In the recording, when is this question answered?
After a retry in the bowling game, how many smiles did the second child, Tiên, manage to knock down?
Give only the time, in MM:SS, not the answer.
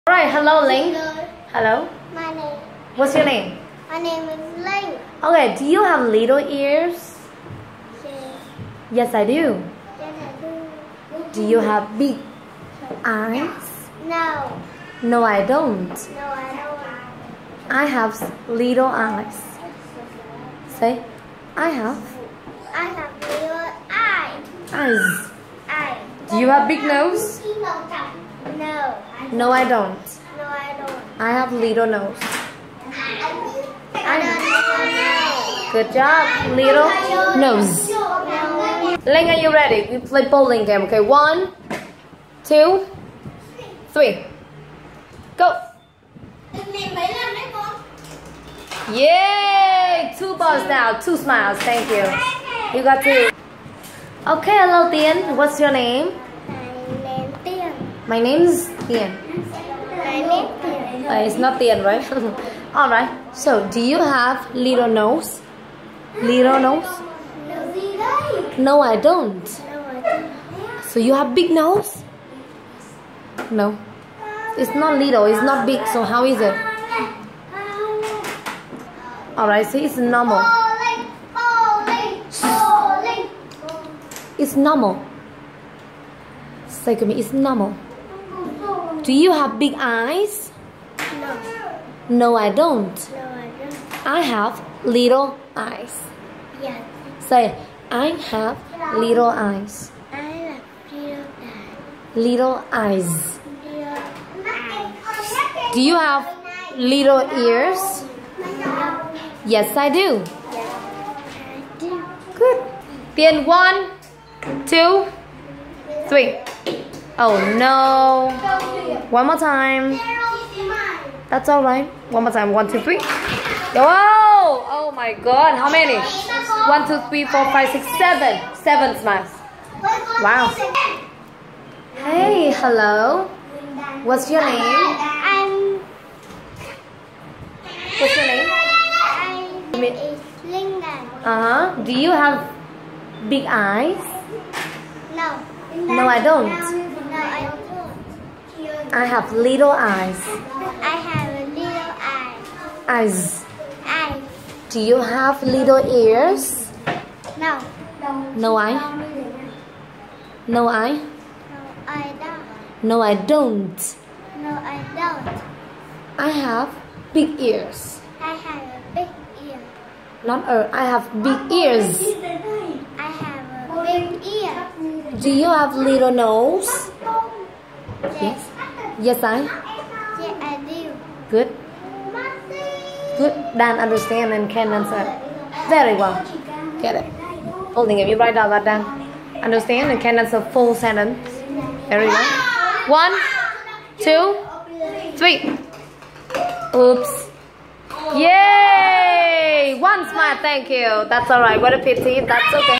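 02:08.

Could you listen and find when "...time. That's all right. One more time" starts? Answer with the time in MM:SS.
01:59.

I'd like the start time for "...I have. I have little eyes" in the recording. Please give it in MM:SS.
00:21.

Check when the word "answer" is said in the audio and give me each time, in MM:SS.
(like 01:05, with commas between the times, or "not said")
03:04, 03:10.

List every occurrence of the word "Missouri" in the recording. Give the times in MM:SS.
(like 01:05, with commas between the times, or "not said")
not said.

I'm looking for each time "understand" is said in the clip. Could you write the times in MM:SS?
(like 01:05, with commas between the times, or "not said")
03:03, 03:09.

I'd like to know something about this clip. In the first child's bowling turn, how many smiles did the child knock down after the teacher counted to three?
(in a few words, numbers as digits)
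2.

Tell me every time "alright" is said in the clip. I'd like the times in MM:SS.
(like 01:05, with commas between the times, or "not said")
03:21.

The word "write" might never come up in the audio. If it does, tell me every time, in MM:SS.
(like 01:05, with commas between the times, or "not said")
03:08.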